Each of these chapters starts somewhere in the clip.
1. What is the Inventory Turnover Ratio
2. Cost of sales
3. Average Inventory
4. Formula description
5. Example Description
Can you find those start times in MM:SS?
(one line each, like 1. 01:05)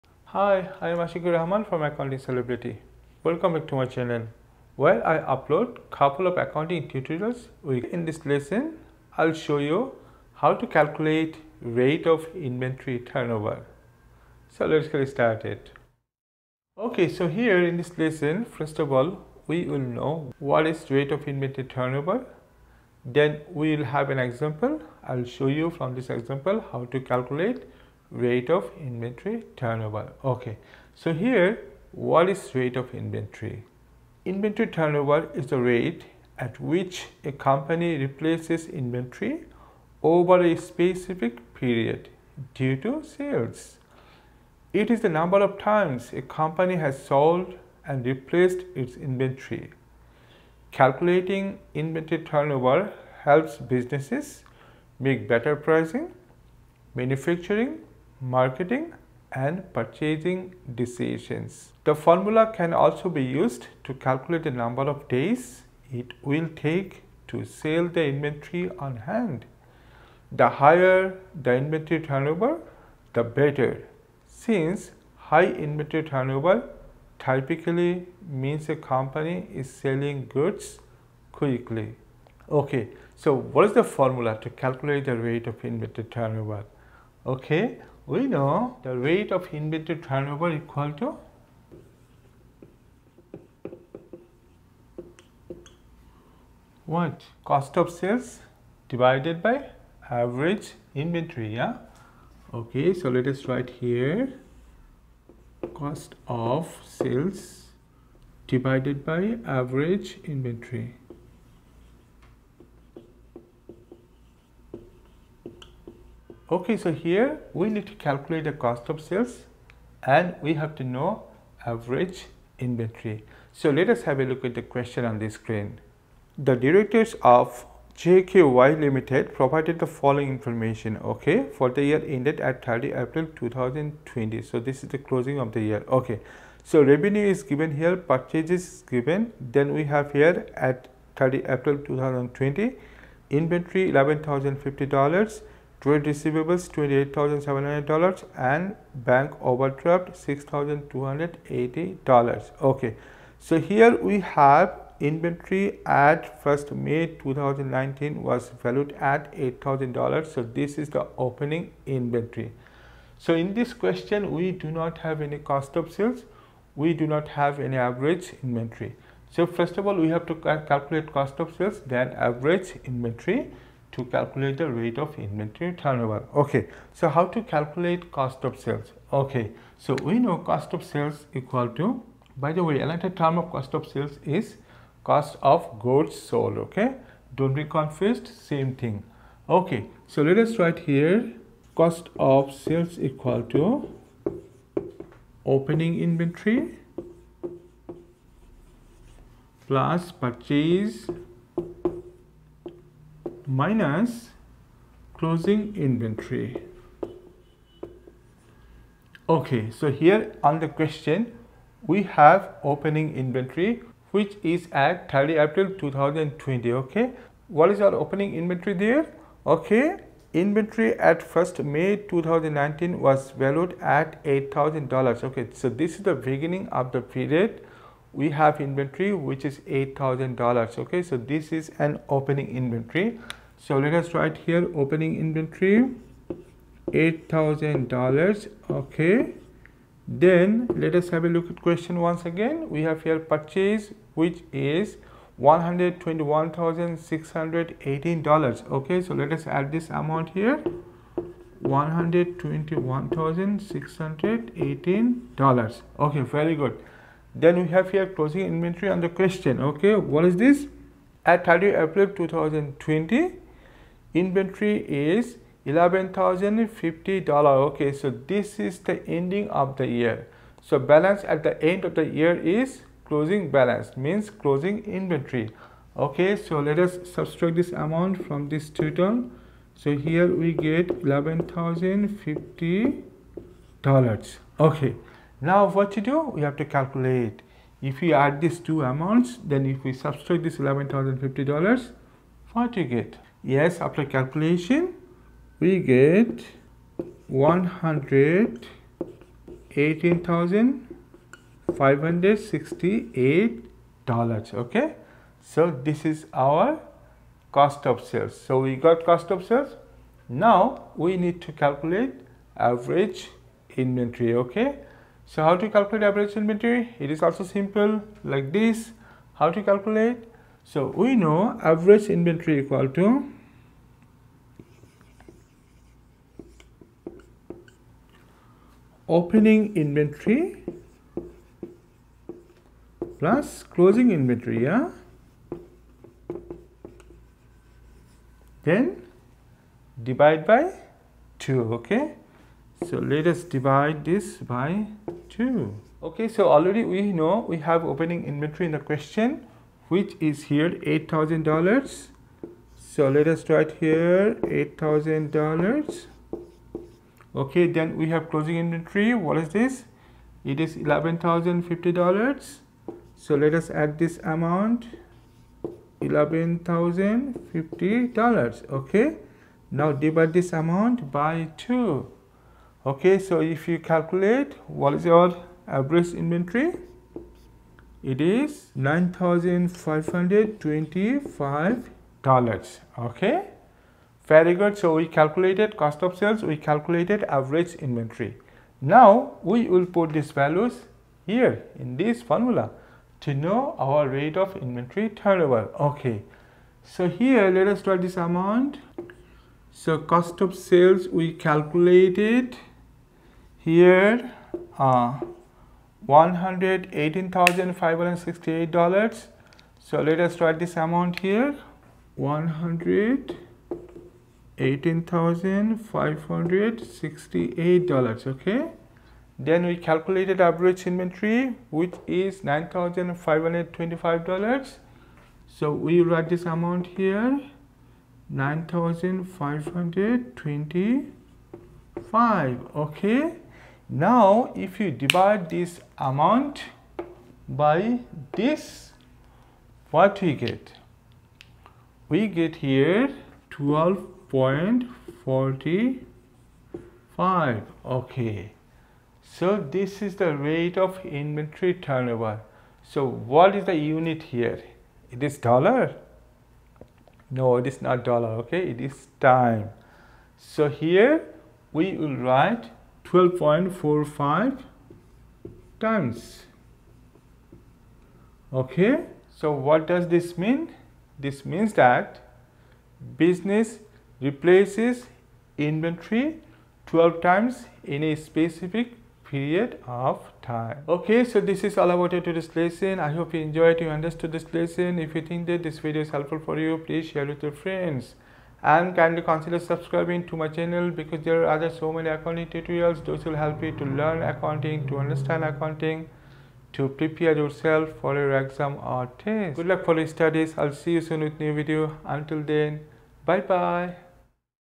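1. 00:33
2. 03:11
3. 05:20
4. 01:25
5. 02:04.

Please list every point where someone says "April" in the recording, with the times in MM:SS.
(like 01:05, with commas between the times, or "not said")
02:13, 02:21, 03:35, 04:21.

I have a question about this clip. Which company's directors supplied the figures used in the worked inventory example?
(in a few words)
JKY Limited.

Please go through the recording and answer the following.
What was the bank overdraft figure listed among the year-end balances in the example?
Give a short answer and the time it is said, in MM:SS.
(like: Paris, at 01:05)
$6,280, at 02:30.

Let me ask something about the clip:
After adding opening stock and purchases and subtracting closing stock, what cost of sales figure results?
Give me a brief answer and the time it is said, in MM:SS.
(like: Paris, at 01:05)
$118,568, at 04:57.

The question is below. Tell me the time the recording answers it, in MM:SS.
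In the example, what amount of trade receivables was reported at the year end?
02:26.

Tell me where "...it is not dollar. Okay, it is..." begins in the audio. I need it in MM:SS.
07:37.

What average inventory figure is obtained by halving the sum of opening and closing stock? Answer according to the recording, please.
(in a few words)
$9,525.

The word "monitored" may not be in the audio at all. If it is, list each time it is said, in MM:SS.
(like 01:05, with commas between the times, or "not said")
not said.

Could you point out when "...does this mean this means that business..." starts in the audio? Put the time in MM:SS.
07:49.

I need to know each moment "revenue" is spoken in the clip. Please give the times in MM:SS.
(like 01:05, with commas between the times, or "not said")
02:16.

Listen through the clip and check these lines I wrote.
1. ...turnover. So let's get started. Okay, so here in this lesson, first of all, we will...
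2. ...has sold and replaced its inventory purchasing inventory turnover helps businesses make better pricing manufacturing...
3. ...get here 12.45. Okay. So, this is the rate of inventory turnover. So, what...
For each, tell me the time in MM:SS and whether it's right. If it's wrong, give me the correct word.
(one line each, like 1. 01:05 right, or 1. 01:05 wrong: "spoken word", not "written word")
1. 00:12 right
2. 00:46 wrong: "calculating", not "purchasing"
3. 07:22 right.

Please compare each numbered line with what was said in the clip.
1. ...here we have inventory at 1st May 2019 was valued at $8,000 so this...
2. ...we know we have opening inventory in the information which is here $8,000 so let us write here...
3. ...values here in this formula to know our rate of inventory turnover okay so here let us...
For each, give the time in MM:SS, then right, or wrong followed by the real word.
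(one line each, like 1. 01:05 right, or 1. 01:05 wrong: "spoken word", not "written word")
1. 02:33 right
2. 05:46 wrong: "question", not "information"
3. 06:30 right.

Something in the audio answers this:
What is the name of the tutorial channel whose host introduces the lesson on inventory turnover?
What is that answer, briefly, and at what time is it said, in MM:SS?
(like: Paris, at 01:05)
Accounting Celebrity, at 00:01.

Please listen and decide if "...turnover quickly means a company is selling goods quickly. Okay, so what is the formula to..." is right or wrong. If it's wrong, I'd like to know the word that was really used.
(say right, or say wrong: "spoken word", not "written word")
wrong: "typically", not "quickly".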